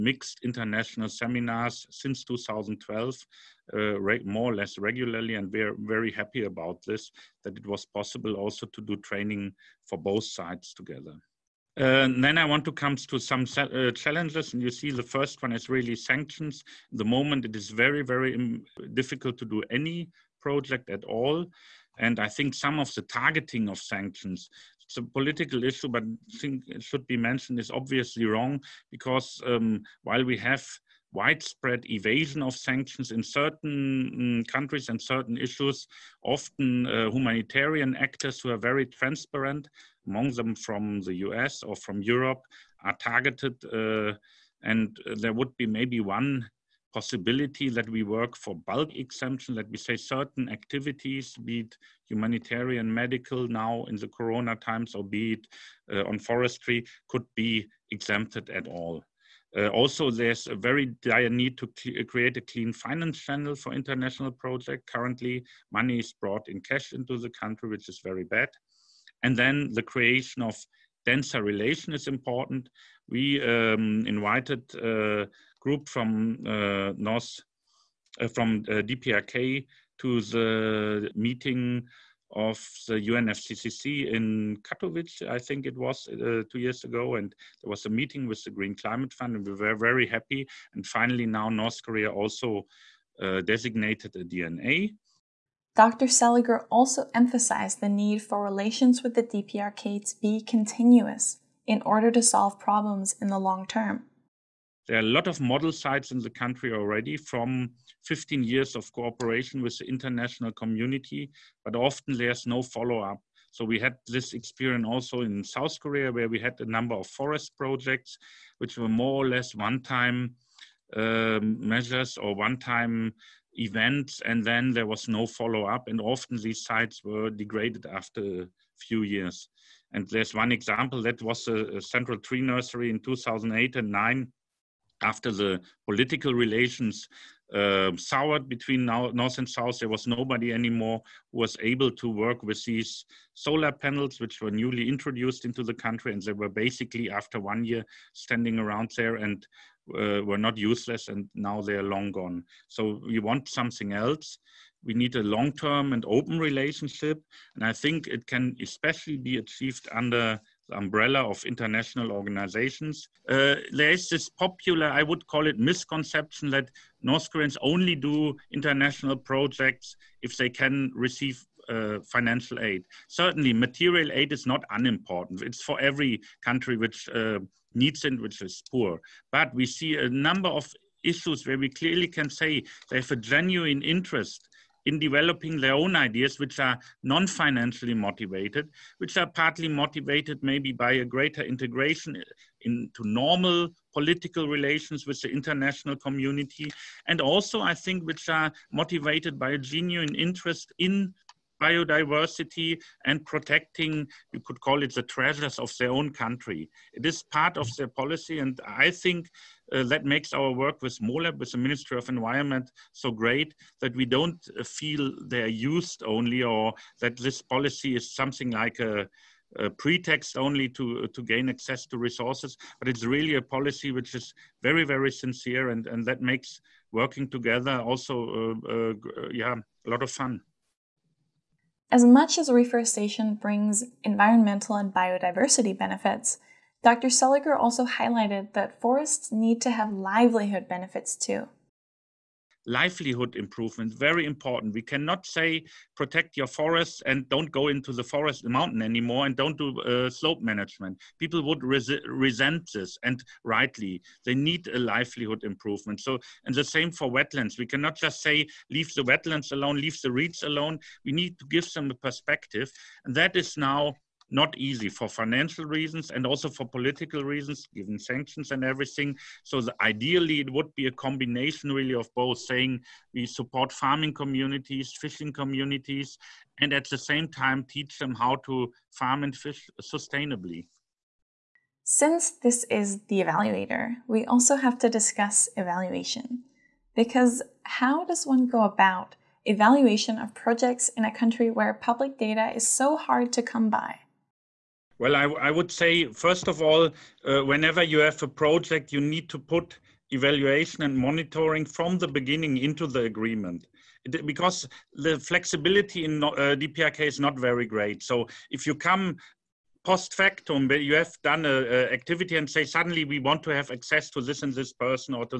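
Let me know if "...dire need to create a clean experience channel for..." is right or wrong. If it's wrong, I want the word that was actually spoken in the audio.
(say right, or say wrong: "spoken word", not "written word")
wrong: "finance", not "experience".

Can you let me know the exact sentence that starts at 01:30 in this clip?
And finally, now North Korea also uh, designated a DNA Dr.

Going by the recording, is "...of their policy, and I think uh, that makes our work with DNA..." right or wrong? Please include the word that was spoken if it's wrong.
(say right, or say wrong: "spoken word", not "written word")
wrong: "MoLEP", not "DNA".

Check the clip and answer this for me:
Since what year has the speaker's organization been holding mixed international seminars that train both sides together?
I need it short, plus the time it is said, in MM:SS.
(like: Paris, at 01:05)
2012, at 00:02.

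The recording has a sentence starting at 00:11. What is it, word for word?
Uh, then I want to come to some uh, challenges, and you see the first one is really sanctions.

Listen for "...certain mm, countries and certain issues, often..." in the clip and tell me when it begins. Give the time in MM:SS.
00:33.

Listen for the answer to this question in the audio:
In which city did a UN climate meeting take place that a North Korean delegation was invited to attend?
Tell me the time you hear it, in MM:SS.
01:24.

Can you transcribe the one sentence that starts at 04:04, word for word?
We cannot say protect your forests and don't go into the forest mountain anymore and don't do uh, slope management.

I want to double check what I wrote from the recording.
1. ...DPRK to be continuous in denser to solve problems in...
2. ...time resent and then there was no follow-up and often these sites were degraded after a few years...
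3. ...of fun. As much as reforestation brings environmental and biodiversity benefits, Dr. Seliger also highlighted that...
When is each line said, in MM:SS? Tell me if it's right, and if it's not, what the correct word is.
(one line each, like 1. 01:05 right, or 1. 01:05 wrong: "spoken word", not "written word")
1. 01:39 wrong: "order", not "denser"
2. 02:02 wrong: "event", not "resent"
3. 03:50 right.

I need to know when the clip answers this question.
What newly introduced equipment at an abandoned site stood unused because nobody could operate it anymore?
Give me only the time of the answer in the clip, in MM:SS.
02:23.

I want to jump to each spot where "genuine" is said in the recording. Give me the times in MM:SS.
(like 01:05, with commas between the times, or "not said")
03:03, 03:19.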